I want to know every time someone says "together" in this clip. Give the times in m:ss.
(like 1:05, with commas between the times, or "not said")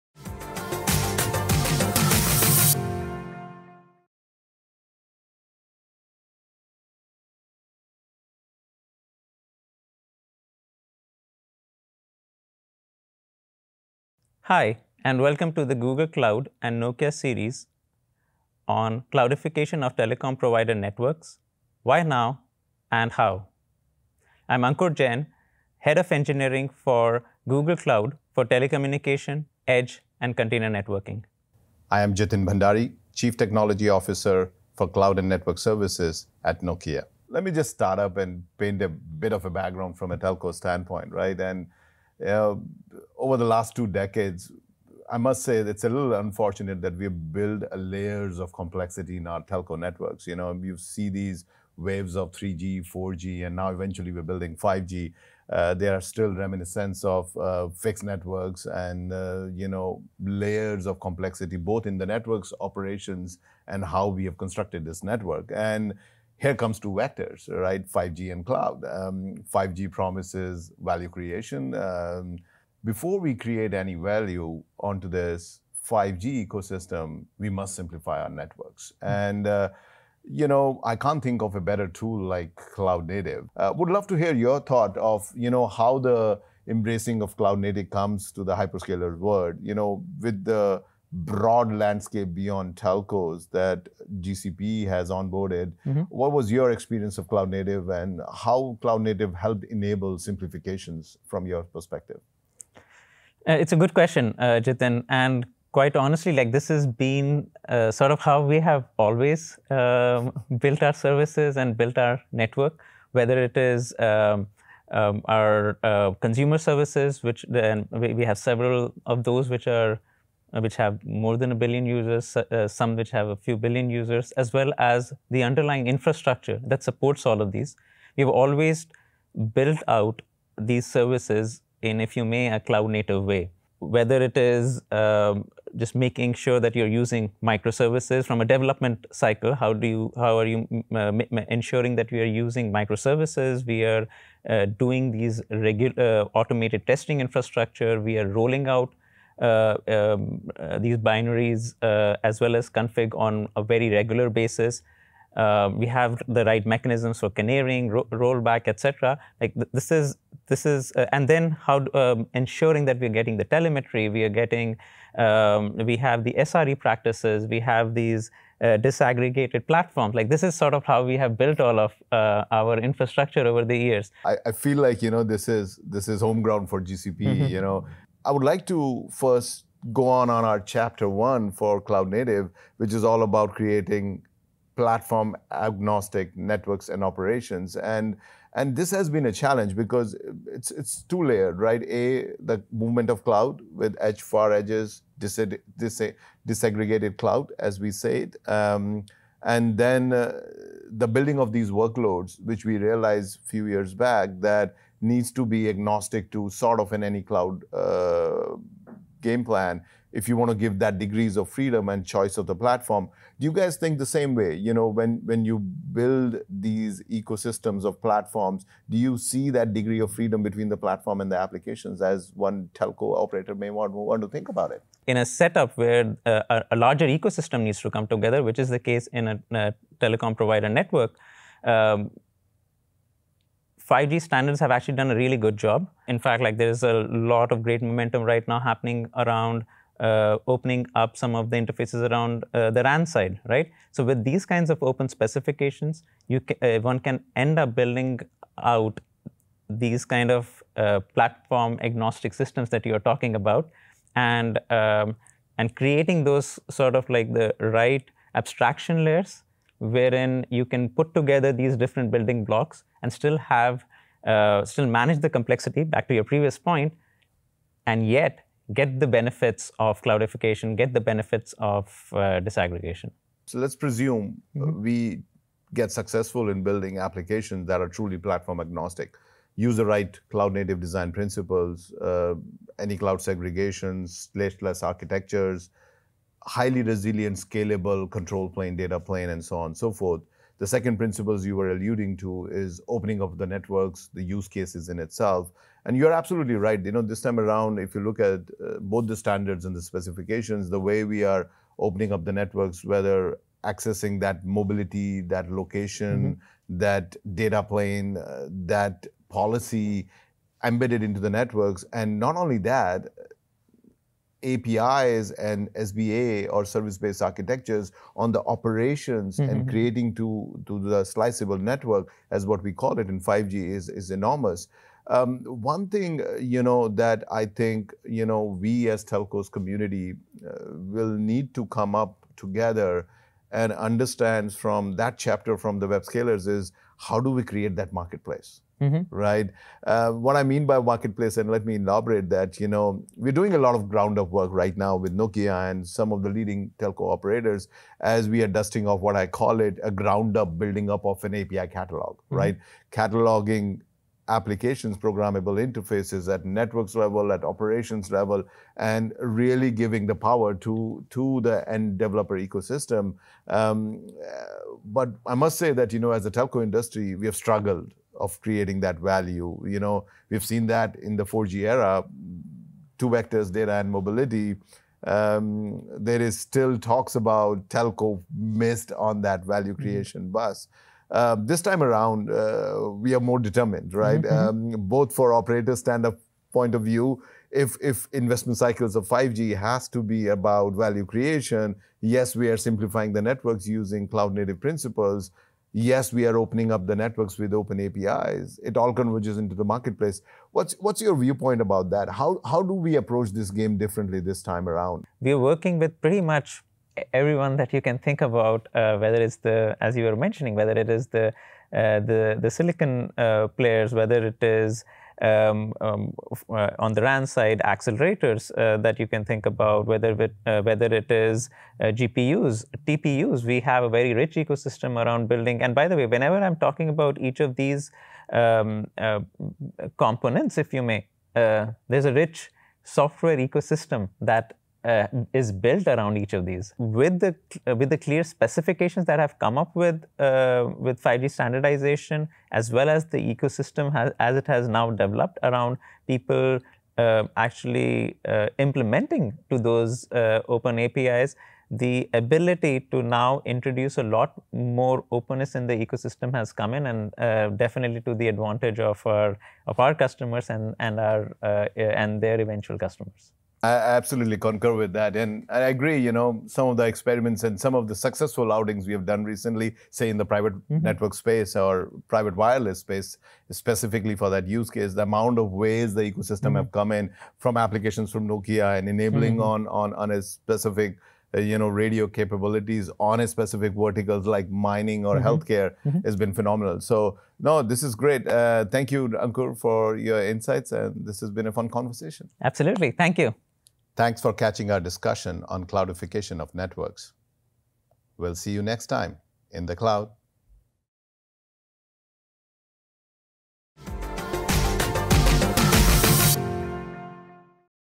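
3:48, 4:21, 5:32.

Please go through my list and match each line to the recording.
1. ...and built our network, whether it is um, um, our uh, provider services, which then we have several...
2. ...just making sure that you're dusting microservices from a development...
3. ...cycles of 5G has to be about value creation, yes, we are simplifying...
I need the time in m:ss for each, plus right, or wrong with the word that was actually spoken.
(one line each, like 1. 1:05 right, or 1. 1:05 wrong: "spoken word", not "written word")
1. 1:51 wrong: "consumer", not "provider"
2. 2:15 wrong: "using", not "dusting"
3. 6:28 right.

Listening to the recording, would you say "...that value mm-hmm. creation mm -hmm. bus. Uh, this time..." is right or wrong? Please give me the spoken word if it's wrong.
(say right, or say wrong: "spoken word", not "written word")
right.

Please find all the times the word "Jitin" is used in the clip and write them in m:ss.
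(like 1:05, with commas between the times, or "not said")
0:32, 1:44.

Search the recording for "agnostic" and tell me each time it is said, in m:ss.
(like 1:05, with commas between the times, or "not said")
3:05, 3:25, 4:11, 4:38.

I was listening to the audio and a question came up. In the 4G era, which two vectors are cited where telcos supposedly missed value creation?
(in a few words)
data and mobility.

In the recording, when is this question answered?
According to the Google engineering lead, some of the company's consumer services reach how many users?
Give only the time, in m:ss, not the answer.
2:03.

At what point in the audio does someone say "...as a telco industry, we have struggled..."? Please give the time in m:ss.
6:06.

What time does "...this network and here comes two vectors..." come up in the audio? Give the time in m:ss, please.
1:04.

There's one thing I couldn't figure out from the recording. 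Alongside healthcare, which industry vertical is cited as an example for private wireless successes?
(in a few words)
mining.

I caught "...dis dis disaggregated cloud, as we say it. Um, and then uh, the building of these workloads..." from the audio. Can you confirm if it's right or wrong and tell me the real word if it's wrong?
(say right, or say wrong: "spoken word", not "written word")
right.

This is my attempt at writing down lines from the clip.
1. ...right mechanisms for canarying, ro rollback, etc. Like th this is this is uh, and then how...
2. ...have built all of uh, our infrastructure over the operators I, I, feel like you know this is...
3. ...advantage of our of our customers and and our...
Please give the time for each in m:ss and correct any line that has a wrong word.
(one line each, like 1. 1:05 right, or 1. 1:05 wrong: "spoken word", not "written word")
1. 2:36 right
2. 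2:51 wrong: "years", not "operators"
3. 7:38 right.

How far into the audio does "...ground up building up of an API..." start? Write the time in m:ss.
5:49.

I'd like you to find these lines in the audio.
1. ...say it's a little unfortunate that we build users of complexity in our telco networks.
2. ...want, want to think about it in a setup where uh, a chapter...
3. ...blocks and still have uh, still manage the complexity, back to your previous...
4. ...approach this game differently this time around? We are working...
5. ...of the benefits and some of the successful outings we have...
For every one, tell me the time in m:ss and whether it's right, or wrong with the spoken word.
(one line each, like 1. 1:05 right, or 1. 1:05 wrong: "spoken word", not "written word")
1. 0:45 wrong: "layers", not "users"
2. 3:43 wrong: "larger", not "chapter"
3. 4:22 right
4. 6:42 right
5. 7:46 wrong: "experiments", not "benefits".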